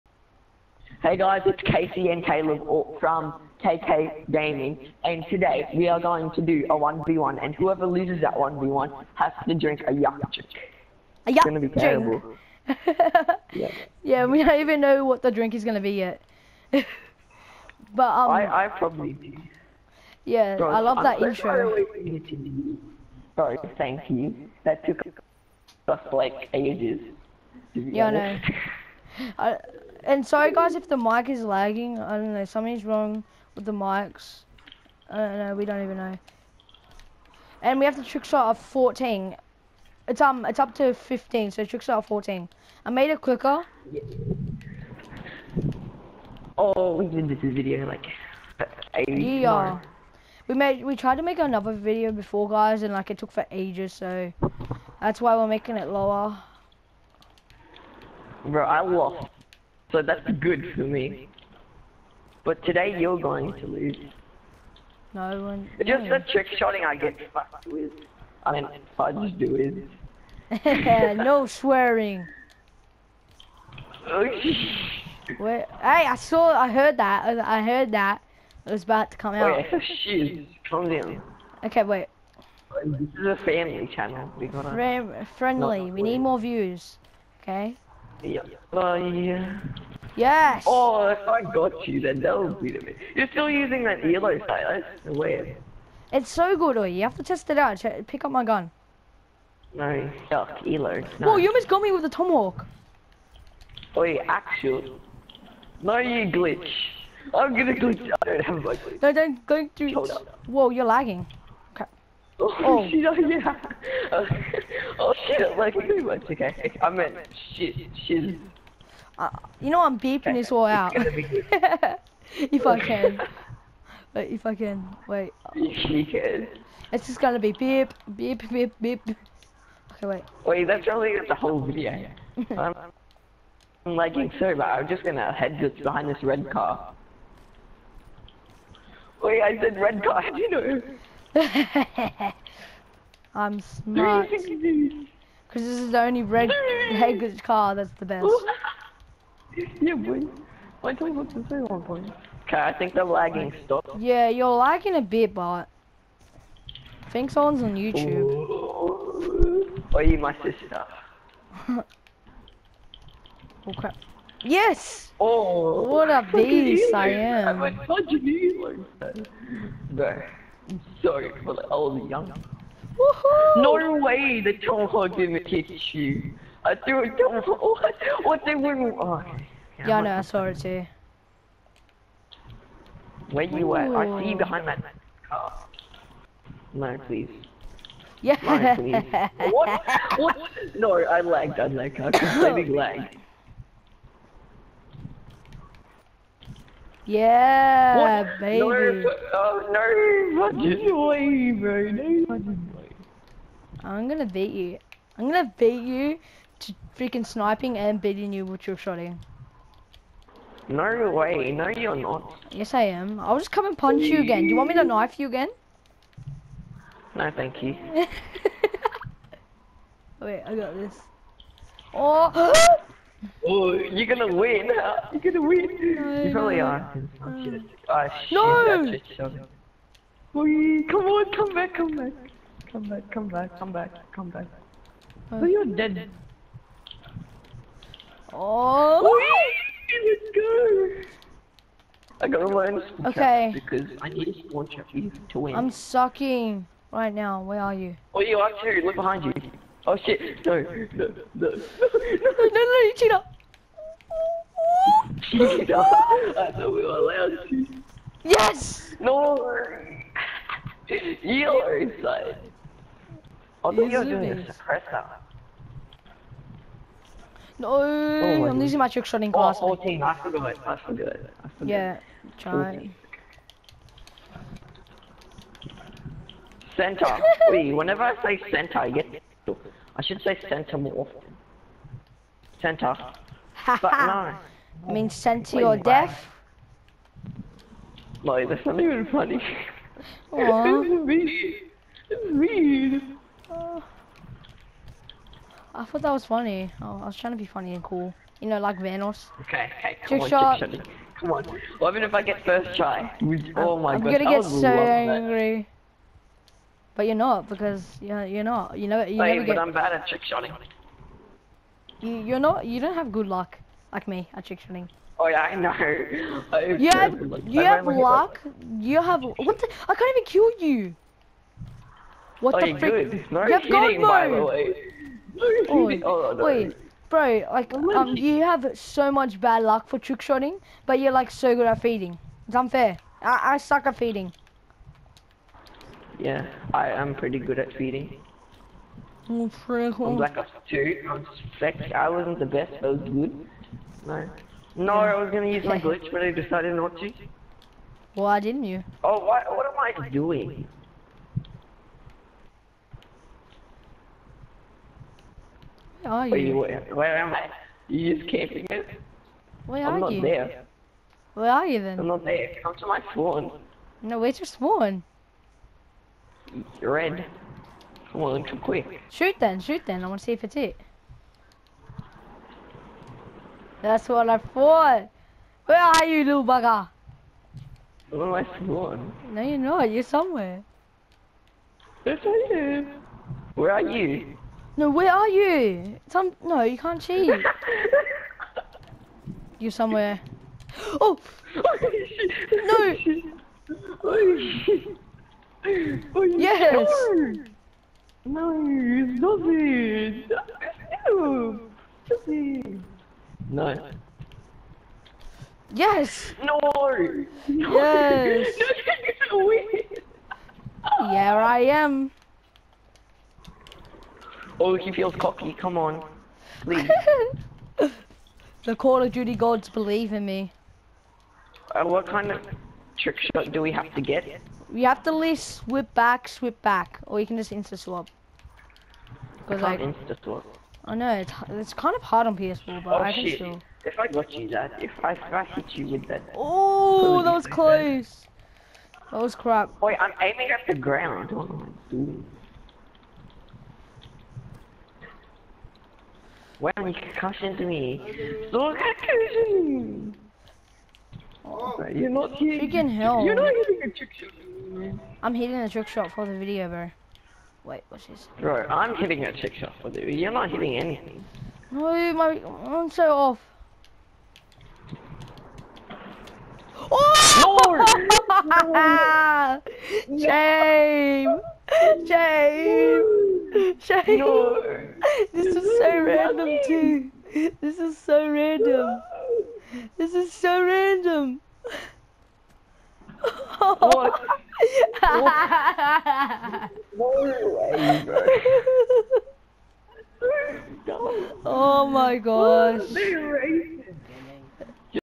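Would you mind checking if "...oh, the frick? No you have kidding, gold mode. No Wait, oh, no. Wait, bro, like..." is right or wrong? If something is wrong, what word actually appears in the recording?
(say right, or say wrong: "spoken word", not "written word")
right.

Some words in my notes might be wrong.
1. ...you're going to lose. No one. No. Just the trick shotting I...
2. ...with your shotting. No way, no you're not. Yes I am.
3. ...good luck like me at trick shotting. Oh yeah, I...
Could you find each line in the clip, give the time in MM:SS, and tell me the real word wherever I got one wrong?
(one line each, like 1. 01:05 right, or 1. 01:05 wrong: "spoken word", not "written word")
1. 01:02 right
2. 03:28 right
3. 05:13 right.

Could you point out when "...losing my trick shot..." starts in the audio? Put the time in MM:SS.
04:28.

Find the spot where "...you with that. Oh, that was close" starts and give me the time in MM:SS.
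07:15.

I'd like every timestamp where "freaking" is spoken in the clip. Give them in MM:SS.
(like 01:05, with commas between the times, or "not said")
03:26, 07:32.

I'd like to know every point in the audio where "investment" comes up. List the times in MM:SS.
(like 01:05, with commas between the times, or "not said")
not said.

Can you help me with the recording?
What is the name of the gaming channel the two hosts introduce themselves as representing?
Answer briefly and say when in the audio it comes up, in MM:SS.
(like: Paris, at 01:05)
KK Gaming, at 00:03.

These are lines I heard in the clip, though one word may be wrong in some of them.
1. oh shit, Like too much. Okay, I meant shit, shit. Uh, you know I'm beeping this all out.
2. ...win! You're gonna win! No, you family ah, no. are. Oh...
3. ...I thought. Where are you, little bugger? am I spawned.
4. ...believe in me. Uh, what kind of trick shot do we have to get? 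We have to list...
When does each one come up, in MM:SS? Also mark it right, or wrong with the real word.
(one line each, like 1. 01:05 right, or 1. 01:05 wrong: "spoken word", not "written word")
1. 01:54 right
2. 03:44 wrong: "probably", not "family"
3. 06:14 right
4. 06:59 right.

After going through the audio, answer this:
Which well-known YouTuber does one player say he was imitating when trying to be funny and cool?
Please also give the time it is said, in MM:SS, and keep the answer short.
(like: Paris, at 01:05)
Vanoss, at 04:58.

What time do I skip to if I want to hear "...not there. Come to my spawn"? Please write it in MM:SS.
06:02.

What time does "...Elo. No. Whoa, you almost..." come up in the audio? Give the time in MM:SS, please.
01:40.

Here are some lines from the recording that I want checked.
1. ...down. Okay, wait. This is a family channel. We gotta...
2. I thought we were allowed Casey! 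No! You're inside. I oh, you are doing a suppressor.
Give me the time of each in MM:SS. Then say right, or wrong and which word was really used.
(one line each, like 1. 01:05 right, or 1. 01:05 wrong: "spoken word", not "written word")
1. 01:20 right
2. 04:16 wrong: "Yes", not "Casey".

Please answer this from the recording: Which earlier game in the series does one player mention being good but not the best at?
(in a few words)
Black Ops 2.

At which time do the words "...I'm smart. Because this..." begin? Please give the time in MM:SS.
02:23.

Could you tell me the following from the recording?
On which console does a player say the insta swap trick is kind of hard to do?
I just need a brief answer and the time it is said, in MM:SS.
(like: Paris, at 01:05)
PS4, at 07:12.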